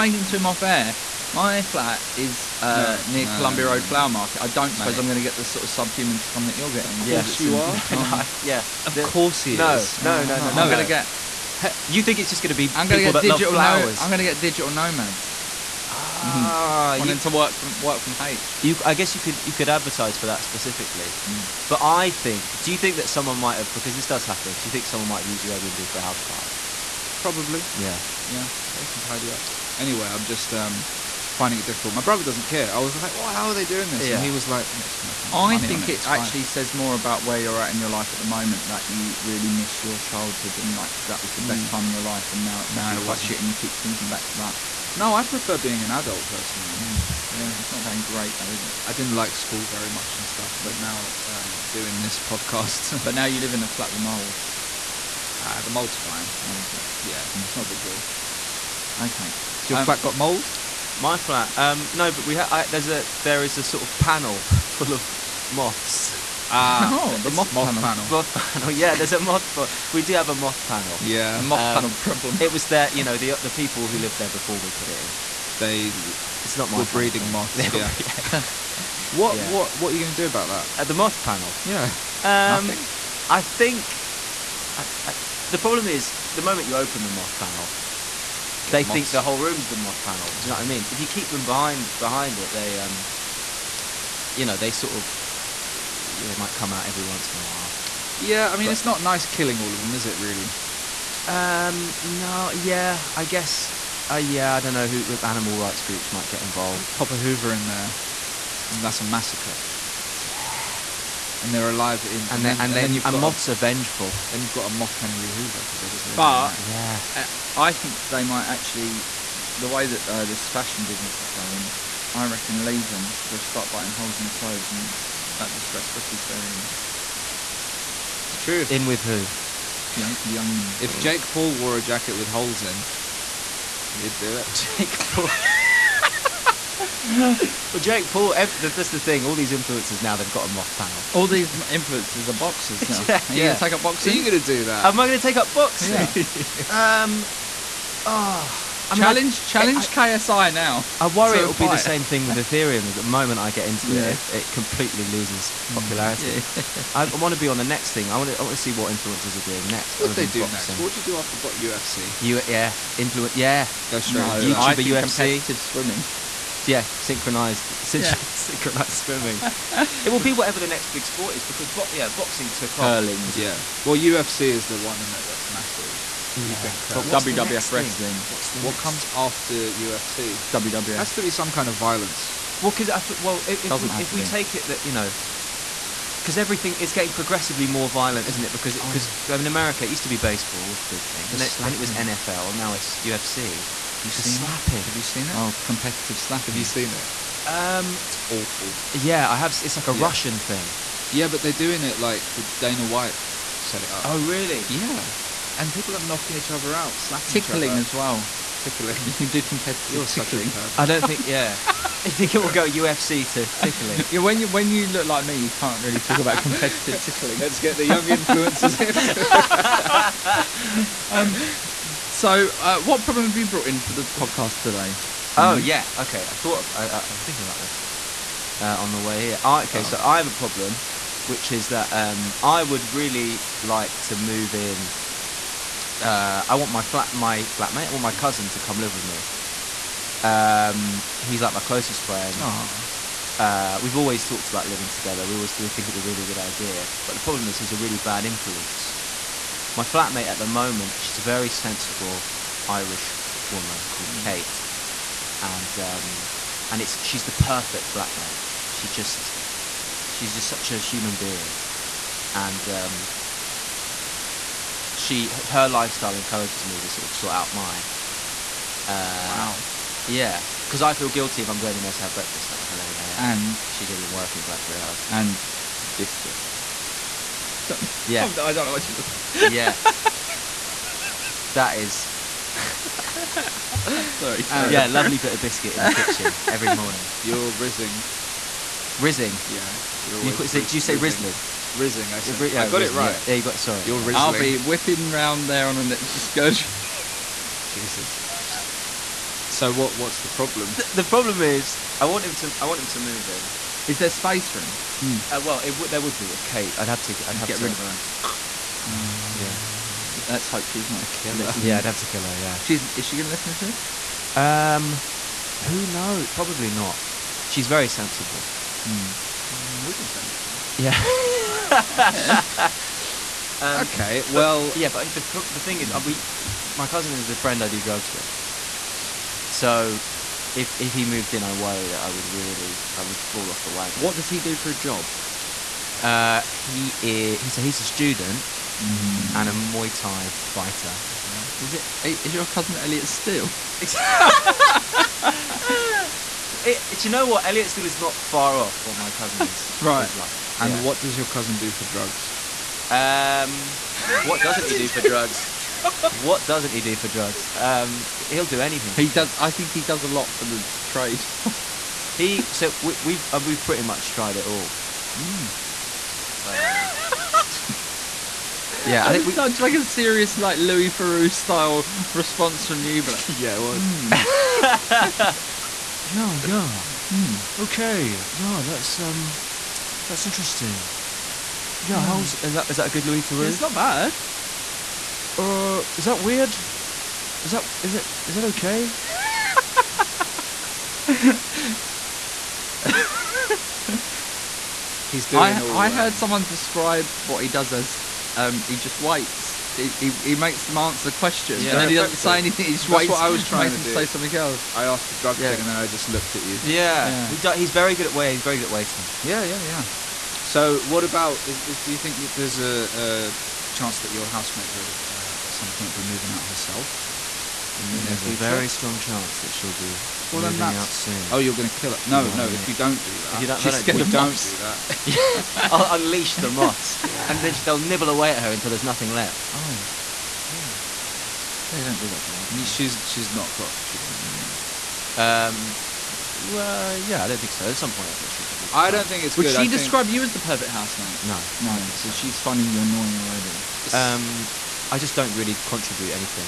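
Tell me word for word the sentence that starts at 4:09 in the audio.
My flatmate at the moment, she's a very sensible Irish woman called mm.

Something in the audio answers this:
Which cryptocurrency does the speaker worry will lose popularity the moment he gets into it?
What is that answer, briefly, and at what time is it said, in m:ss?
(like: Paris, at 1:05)
Ethereum, at 2:32.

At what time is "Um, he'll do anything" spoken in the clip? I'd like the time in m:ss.
5:57.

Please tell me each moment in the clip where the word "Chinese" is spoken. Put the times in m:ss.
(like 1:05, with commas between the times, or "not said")
not said.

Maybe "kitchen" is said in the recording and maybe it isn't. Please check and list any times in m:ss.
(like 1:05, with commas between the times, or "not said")
4:46.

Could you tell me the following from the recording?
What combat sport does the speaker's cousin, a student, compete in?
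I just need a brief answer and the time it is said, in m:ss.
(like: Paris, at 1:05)
Muay Thai, at 5:39.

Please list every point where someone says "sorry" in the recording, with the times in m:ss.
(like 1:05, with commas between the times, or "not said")
4:44, 4:53.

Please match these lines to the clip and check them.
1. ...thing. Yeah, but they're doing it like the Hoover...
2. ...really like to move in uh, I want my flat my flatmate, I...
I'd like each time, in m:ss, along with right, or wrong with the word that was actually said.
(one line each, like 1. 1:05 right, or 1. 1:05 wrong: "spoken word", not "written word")
1. 3:20 wrong: "Dana", not "Hoover"
2. 3:52 right.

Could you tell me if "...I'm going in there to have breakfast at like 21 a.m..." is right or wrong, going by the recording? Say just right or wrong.
wrong.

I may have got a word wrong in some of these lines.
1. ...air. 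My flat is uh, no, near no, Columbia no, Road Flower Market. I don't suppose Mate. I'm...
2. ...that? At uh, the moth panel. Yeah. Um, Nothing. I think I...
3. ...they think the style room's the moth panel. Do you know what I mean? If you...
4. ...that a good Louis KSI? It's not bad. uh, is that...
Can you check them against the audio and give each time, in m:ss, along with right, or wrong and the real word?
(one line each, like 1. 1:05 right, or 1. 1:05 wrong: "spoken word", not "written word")
1. 0:00 right
2. 1:20 right
3. 1:28 wrong: "whole", not "style"
4. 6:22 wrong: "Theroux", not "KSI".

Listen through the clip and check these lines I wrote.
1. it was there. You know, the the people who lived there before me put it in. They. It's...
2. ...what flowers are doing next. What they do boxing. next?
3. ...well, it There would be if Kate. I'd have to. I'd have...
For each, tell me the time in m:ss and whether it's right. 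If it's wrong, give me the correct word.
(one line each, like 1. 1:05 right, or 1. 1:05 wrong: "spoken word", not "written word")
1. 1:12 right
2. 2:38 wrong: "influencers", not "flowers"
3. 5:05 right.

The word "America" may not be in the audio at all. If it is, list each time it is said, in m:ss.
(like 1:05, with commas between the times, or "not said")
3:09.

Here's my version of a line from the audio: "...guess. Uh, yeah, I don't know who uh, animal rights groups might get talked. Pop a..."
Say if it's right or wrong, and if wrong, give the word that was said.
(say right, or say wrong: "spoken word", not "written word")
wrong: "involved", not "talked".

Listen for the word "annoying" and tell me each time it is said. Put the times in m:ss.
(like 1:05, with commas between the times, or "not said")
7:22.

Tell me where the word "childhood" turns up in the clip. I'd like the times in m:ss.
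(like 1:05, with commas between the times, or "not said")
0:39.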